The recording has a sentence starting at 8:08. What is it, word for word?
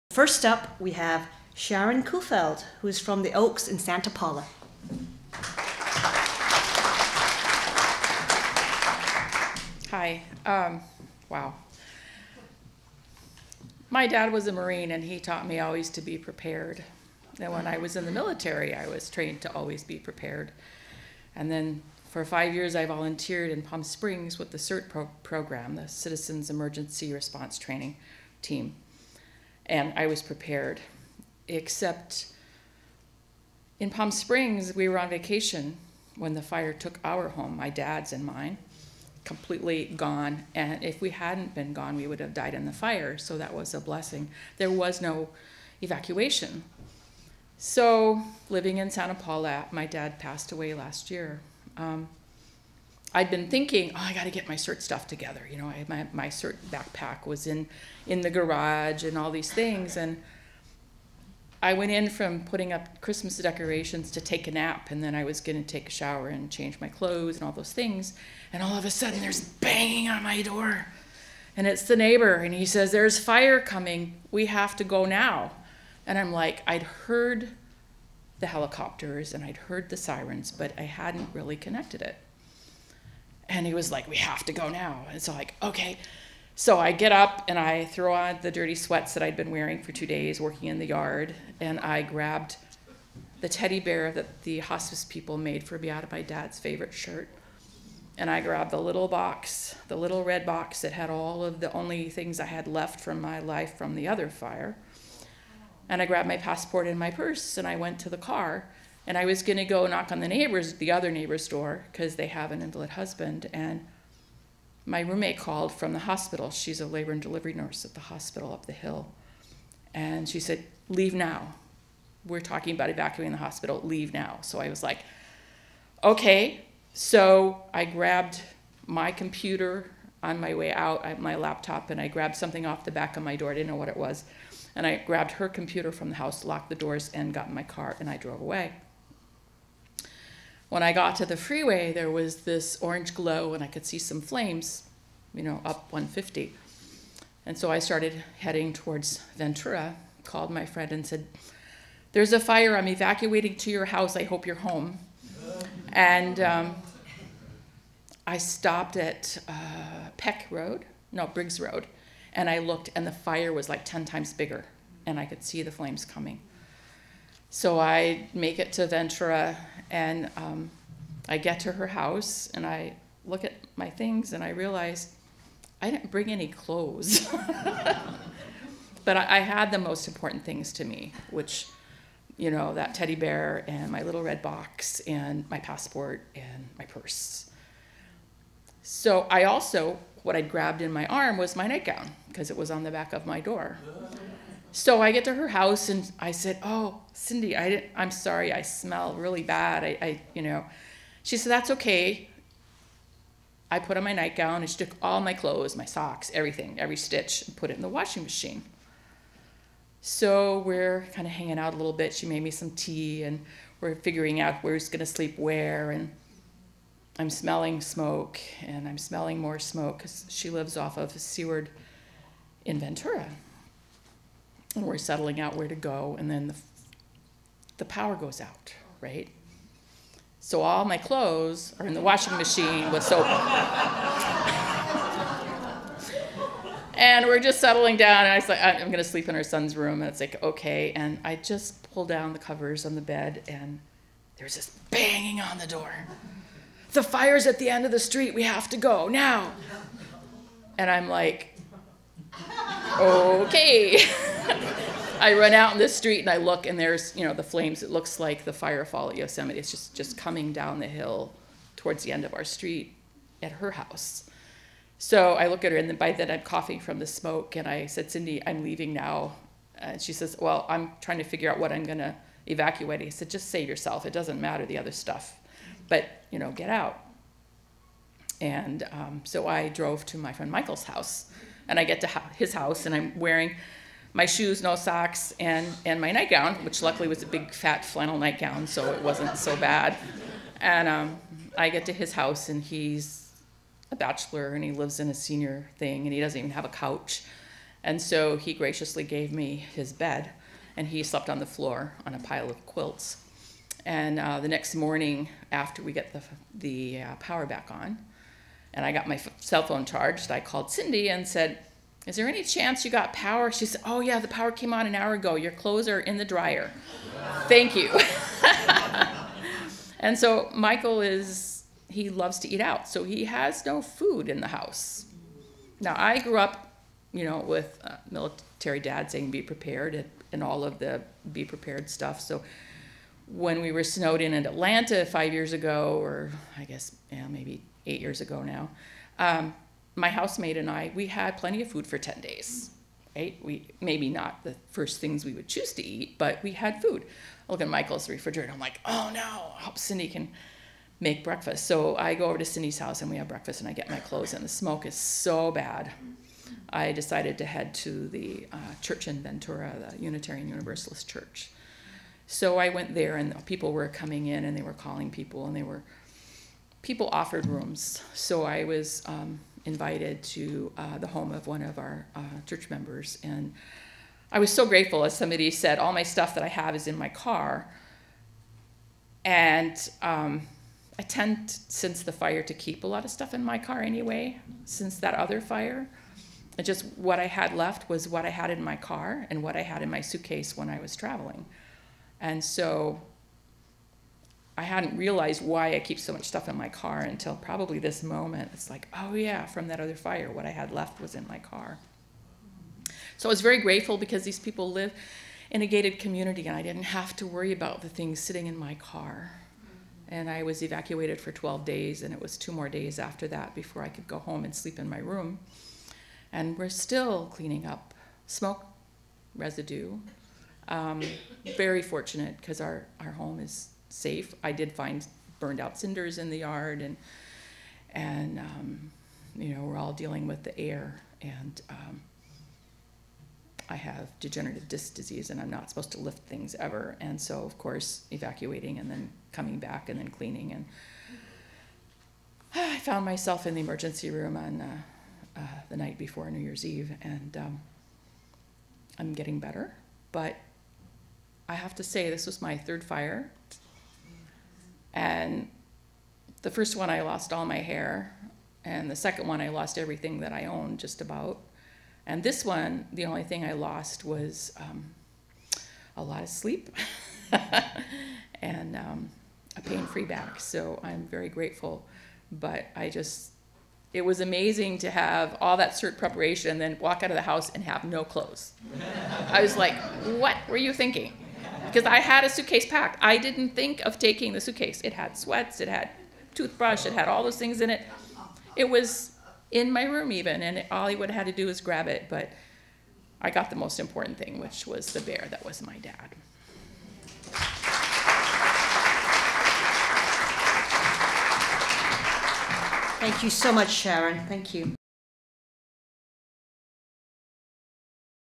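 It was in my room even, and all I would have had to do was grab it.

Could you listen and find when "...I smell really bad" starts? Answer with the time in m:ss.
3:18.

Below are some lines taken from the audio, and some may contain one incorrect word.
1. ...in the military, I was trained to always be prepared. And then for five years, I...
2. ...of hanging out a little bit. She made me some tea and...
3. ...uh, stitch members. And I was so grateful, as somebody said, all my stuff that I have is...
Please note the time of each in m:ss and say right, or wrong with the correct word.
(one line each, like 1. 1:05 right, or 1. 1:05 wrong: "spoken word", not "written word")
1. 0:17 right
2. 3:31 right
3. 6:12 wrong: "church", not "stitch".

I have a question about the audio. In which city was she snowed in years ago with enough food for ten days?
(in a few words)
Atlanta.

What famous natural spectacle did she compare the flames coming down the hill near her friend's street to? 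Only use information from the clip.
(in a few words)
Firefall at Yosemite.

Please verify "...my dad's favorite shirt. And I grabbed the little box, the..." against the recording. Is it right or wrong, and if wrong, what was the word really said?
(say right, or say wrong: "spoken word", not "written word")
right.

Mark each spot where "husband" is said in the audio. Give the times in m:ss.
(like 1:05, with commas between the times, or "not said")
1:52.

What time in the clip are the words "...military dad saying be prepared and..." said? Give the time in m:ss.
5:28.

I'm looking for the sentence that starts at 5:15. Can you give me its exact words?
Your clothes are in the dryer.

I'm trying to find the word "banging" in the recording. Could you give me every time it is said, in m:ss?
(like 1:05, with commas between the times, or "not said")
1:09, 4:04.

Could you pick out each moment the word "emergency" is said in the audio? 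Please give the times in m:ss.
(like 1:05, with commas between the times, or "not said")
0:26, 7:23.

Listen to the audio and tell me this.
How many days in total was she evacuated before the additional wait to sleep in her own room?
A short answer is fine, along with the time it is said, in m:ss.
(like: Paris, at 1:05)
12, at 6:51.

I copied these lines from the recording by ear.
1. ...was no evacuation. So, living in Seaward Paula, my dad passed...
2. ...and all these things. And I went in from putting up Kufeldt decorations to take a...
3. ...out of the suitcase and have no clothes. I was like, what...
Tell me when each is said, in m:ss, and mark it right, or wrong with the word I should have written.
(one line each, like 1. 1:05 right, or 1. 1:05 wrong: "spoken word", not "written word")
1. 0:44 wrong: "Santa", not "Seaward"
2. 0:59 wrong: "Christmas", not "Kufeldt"
3. 7:57 wrong: "house", not "suitcase".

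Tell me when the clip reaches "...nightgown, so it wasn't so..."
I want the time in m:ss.
4:48.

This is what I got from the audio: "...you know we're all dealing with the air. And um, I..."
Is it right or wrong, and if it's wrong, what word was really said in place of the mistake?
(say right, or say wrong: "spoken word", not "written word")
right.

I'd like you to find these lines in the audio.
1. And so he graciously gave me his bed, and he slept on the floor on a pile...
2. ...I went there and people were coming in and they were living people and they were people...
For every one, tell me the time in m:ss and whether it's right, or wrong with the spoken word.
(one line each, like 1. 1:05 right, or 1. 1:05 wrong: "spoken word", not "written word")
1. 4:57 right
2. 6:02 wrong: "calling", not "living".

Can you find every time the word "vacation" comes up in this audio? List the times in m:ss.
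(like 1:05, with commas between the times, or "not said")
0:35.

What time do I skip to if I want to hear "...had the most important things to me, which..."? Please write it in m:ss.
2:59.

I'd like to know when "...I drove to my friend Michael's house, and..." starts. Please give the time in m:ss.
4:39.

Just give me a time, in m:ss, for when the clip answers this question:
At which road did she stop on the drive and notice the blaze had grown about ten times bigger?
2:41.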